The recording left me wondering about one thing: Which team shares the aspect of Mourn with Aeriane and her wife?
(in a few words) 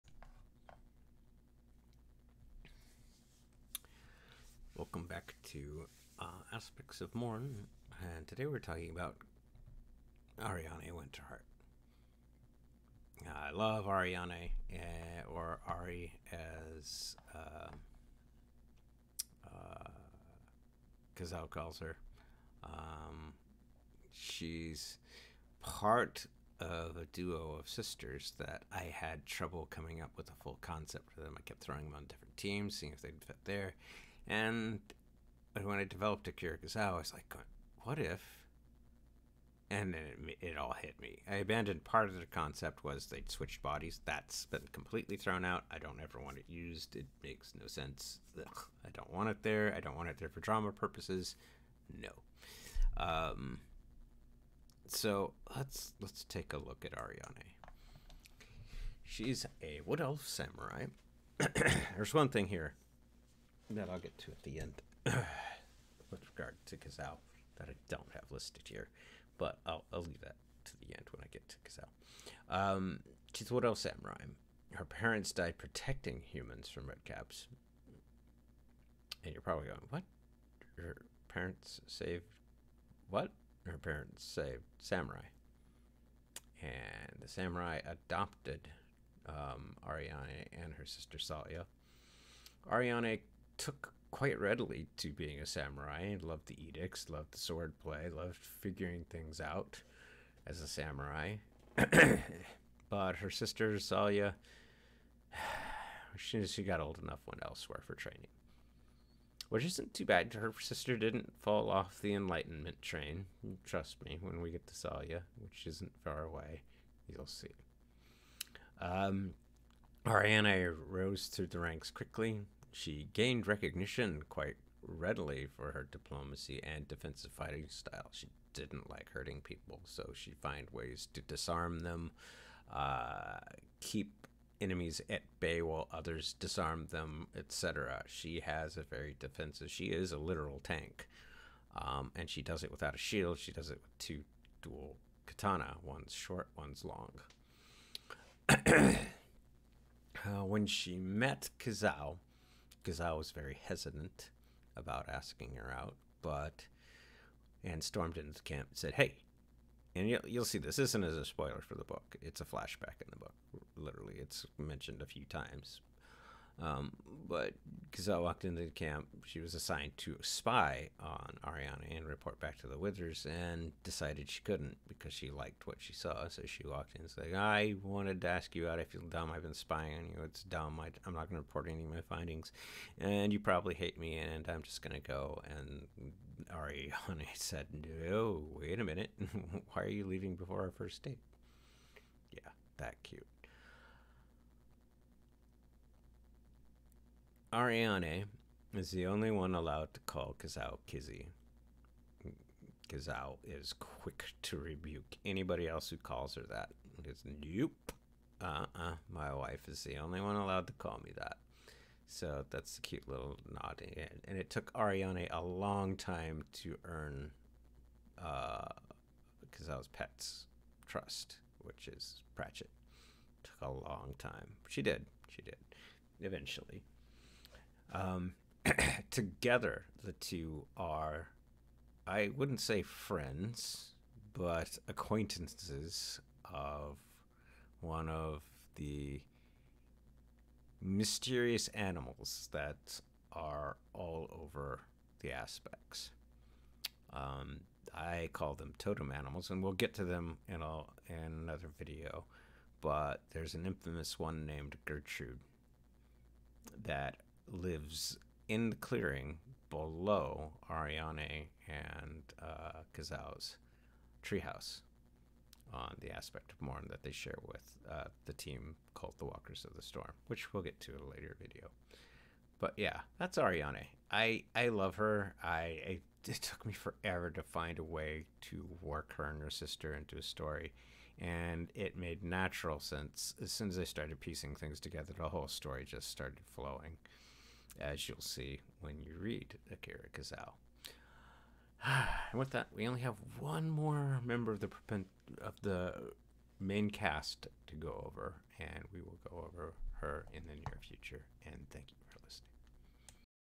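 Walkers of the Storm.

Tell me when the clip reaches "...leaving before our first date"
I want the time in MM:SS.
03:10.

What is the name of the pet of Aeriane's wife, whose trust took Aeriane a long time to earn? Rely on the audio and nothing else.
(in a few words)
Pratchett.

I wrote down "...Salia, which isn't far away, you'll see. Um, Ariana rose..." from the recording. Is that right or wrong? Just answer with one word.
right.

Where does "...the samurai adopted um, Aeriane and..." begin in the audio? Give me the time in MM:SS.
01:27.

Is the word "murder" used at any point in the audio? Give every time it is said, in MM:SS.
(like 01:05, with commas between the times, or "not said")
not said.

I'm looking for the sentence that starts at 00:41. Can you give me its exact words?
I abandoned part of the concept was they'd switched bodies.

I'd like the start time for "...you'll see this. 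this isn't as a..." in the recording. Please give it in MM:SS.
02:40.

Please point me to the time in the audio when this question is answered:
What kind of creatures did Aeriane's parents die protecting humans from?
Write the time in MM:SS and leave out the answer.
01:16.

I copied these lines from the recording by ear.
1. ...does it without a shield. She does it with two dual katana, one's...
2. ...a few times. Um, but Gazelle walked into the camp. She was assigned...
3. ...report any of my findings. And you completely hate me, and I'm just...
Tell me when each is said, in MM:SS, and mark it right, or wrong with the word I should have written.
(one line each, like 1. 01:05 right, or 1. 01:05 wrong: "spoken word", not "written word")
1. 02:22 right
2. 02:45 right
3. 03:01 wrong: "probably", not "completely".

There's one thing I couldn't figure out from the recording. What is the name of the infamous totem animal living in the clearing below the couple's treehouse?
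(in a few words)
Gertrude.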